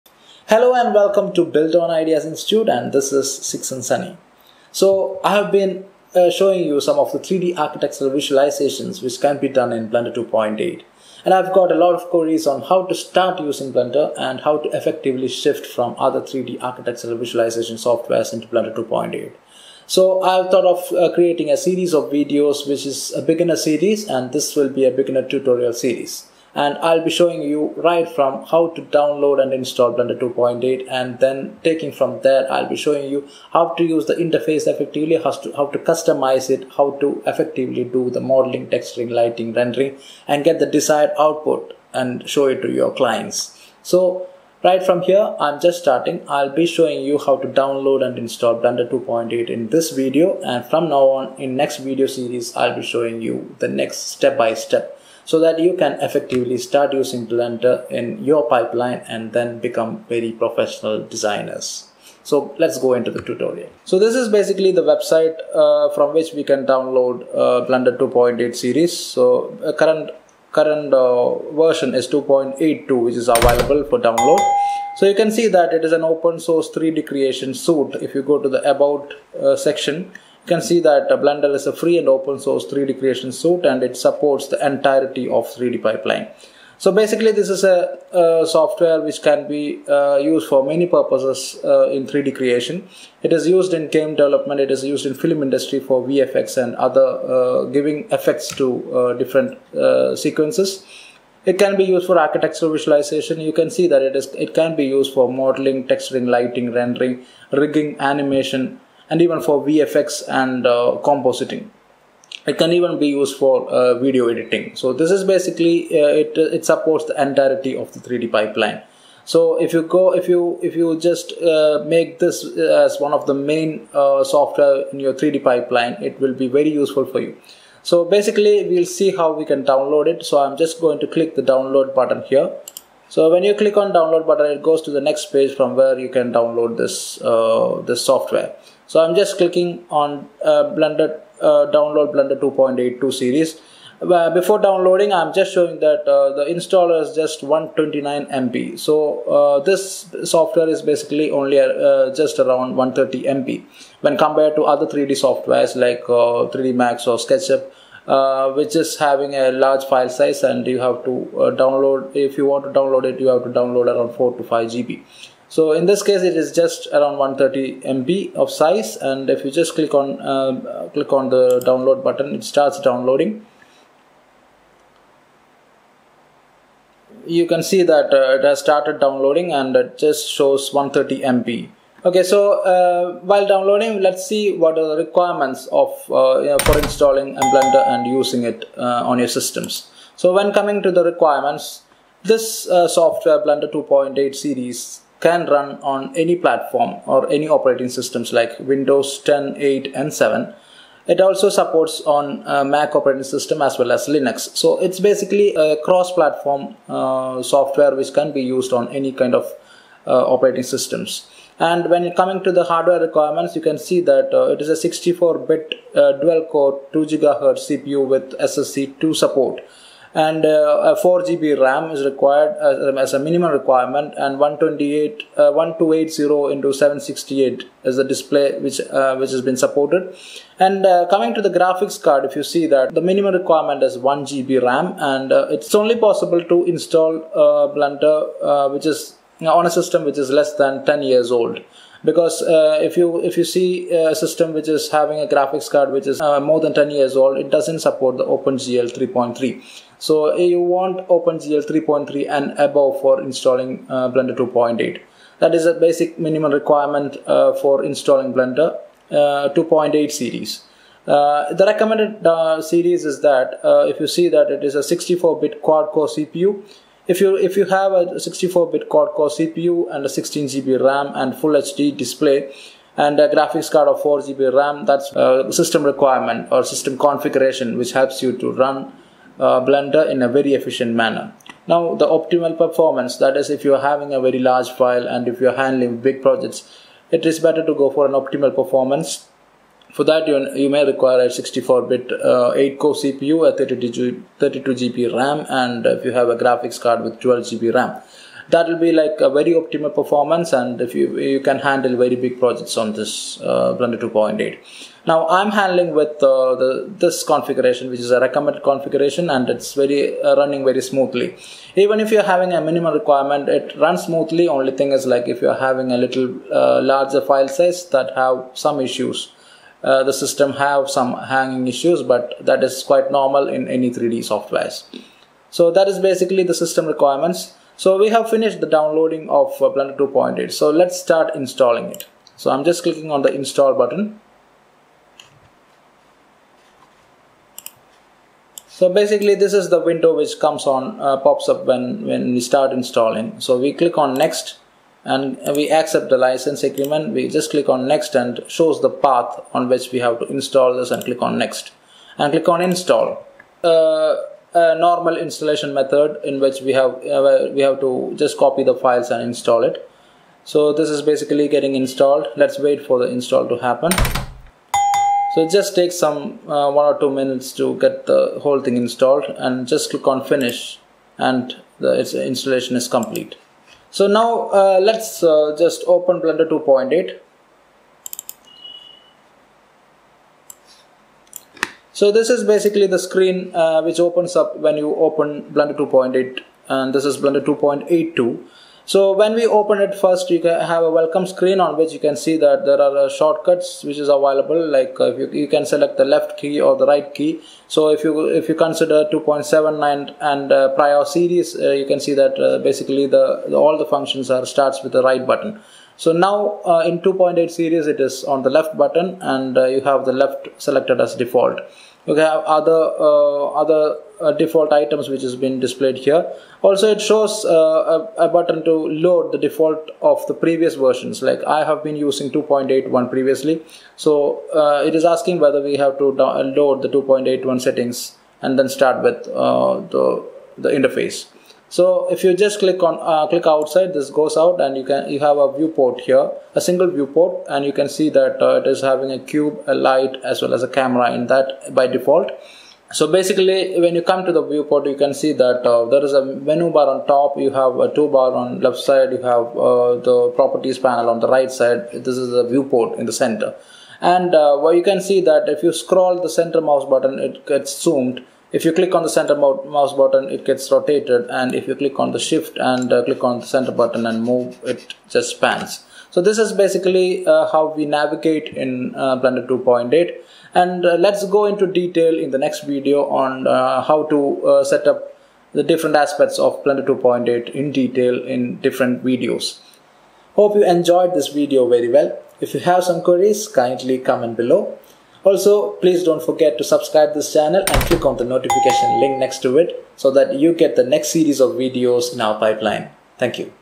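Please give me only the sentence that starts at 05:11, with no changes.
Even if you're having a minimal requirement, it runs smoothly.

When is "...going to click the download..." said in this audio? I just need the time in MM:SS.
02:10.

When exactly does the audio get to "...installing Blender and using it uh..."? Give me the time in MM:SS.
03:06.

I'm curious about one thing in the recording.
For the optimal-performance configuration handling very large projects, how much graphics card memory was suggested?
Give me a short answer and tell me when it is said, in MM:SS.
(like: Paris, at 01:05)
12 GB, at 04:57.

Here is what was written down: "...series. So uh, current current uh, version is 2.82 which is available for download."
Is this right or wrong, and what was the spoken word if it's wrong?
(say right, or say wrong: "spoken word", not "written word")
right.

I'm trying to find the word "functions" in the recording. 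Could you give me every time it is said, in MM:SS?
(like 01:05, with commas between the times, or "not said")
06:43.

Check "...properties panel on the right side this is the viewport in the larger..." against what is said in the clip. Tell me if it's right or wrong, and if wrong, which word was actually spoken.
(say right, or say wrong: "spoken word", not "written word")
wrong: "center", not "larger".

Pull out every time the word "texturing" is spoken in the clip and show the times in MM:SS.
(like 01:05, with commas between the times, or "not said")
00:38, 01:45.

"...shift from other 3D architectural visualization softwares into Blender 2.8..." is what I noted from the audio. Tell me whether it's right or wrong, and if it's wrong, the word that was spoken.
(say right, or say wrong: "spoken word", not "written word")
right.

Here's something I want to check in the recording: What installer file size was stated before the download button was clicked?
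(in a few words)
129 MB.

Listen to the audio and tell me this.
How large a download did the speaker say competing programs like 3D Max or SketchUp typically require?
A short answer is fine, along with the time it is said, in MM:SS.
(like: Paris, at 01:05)
4 to 5 GB, at 02:44.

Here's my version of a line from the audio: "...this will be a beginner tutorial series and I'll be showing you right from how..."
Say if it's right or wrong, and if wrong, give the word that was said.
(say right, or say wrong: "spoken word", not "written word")
right.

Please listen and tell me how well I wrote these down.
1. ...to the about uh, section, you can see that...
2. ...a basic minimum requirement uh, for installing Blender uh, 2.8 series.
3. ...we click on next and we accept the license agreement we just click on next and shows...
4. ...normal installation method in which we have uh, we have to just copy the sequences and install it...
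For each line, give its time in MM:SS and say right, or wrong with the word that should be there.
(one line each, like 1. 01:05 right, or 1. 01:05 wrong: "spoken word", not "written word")
1. 01:18 right
2. 04:15 right
3. 05:43 right
4. 05:54 wrong: "files", not "sequences".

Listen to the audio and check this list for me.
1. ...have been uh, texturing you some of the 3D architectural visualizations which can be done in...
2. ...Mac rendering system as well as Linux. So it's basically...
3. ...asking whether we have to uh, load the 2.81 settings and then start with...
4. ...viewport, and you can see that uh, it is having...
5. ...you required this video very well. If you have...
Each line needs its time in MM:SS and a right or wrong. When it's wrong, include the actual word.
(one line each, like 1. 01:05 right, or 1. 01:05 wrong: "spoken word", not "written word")
1. 00:05 wrong: "showing", not "texturing"
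2. 03:22 wrong: "operating", not "rendering"
3. 07:05 right
4. 07:16 right
5. 08:00 wrong: "enjoyed", not "required".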